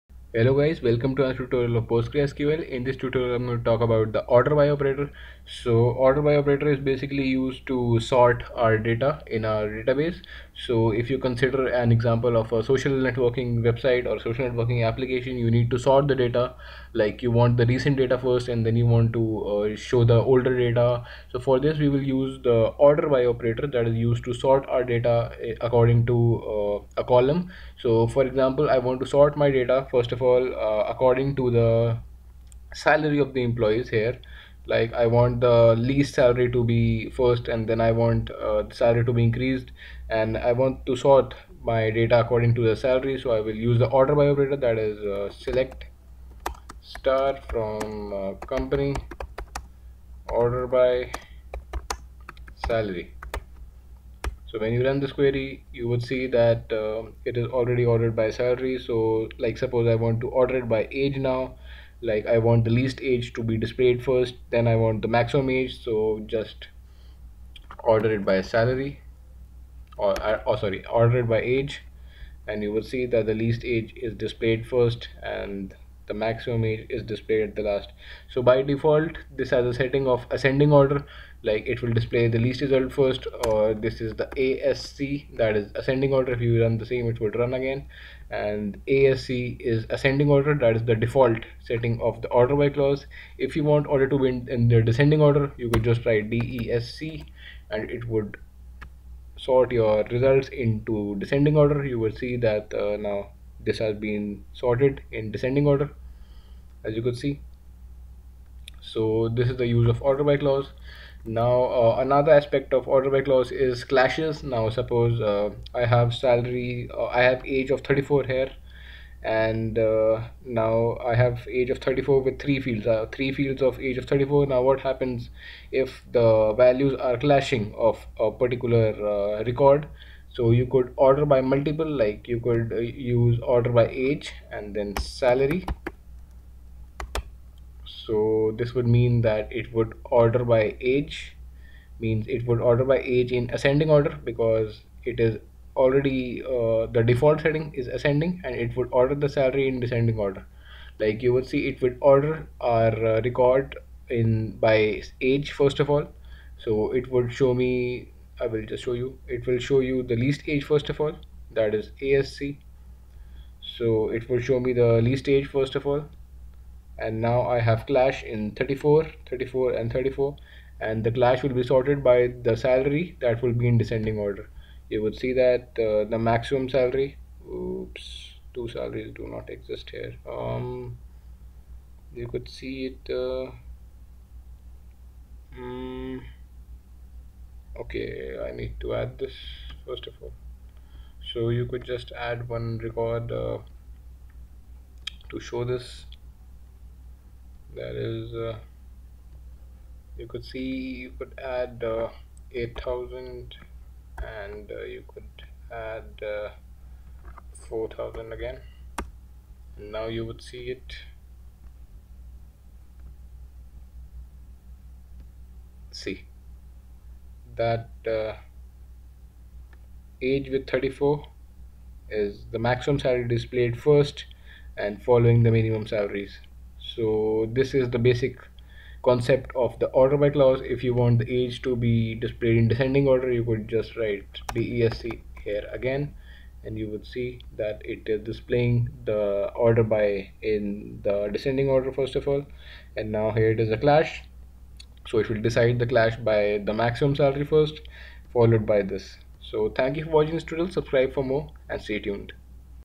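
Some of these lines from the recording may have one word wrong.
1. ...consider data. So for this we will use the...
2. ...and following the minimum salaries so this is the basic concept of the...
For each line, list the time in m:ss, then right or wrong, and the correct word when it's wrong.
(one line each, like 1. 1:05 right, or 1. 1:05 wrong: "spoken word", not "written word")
1. 0:20 wrong: "older", not "consider"
2. 3:44 right.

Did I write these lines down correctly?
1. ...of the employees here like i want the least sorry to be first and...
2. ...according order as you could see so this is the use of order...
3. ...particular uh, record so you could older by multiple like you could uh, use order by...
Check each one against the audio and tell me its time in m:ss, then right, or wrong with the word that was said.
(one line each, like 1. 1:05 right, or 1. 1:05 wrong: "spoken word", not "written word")
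1. 0:33 wrong: "salary", not "sorry"
2. 1:45 wrong: "descending", not "according"
3. 2:08 wrong: "order", not "older".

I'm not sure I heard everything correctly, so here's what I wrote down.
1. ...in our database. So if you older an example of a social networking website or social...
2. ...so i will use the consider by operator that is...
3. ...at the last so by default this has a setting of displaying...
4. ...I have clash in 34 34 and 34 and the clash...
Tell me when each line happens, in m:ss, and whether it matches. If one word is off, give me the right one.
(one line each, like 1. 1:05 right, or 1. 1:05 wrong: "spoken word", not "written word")
1. 0:09 wrong: "consider", not "older"
2. 0:43 wrong: "order", not "consider"
3. 1:17 wrong: "ascending", not "displaying"
4. 2:47 right.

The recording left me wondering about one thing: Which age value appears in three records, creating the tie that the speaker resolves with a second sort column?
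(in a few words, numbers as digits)
34.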